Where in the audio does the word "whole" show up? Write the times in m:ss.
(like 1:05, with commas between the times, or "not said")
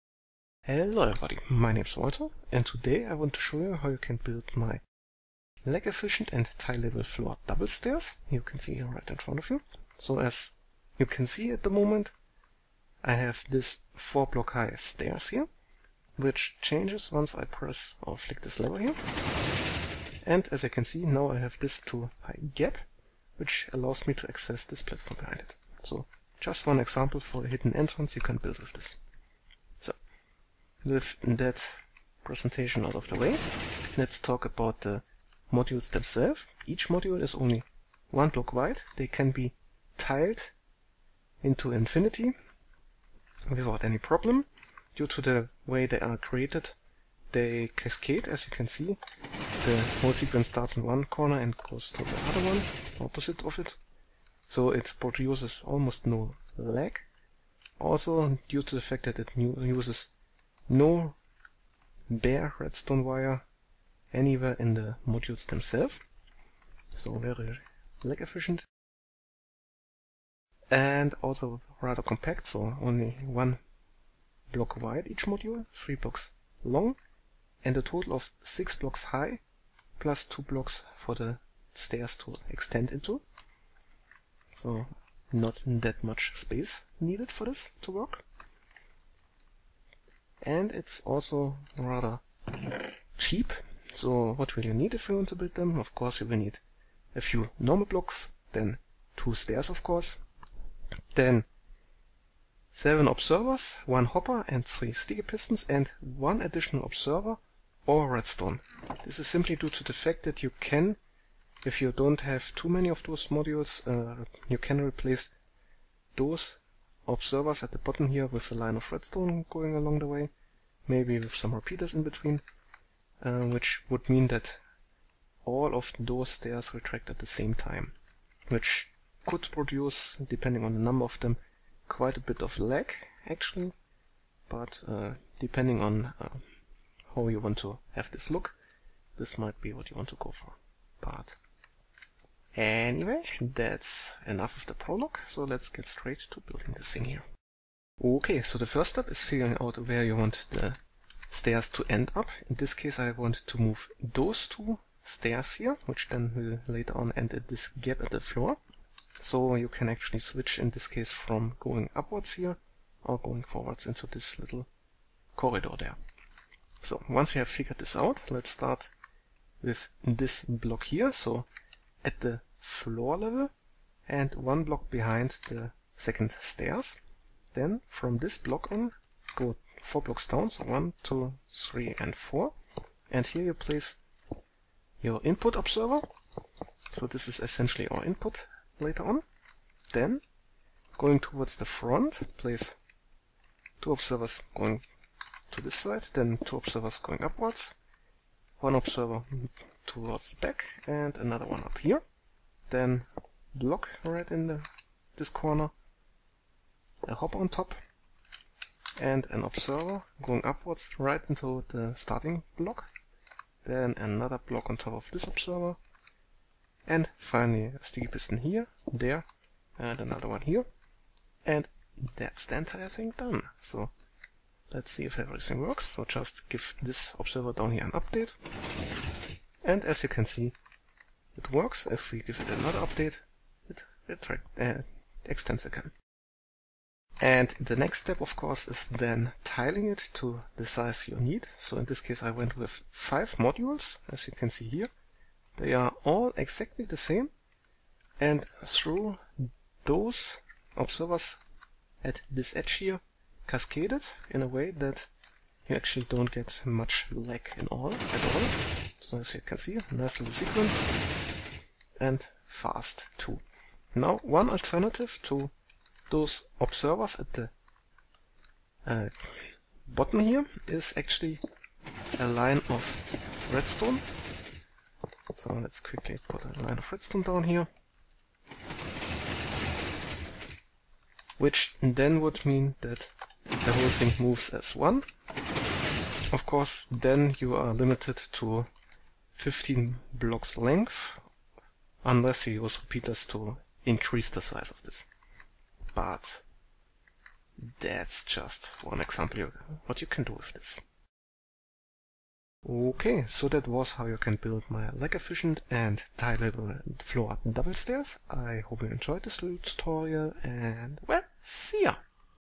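0:50, 4:43.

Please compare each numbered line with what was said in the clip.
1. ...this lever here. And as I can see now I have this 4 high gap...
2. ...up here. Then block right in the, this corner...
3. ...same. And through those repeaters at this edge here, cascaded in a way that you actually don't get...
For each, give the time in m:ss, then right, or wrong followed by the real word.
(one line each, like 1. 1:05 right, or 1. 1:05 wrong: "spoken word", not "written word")
1. 0:18 wrong: "2", not "4"
2. 3:21 right
3. 4:06 wrong: "observers", not "repeaters".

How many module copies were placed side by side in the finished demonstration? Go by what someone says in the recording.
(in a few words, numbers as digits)
5.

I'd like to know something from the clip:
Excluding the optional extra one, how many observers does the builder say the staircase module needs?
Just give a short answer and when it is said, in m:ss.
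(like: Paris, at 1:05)
7, at 1:42.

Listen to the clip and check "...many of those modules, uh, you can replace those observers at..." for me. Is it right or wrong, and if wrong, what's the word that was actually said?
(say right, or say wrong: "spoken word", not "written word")
right.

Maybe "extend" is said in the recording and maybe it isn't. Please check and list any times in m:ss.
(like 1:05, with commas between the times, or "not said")
1:22, 3:55.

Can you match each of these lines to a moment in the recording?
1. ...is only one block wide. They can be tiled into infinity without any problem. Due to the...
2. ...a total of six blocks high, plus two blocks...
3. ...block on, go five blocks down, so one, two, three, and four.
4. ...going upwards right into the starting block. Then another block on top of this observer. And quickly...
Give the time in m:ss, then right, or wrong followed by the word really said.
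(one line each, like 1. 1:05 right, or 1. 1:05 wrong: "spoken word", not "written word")
1. 0:37 right
2. 1:17 right
3. 2:58 wrong: "four", not "five"
4. 3:30 wrong: "finally", not "quickly".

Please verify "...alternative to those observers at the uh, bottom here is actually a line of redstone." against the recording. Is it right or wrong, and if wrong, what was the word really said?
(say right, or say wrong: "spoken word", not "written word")
right.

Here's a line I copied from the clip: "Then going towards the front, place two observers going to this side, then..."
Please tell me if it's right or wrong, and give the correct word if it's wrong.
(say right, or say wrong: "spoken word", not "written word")
right.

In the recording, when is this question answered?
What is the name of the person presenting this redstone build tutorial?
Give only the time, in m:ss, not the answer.
0:01.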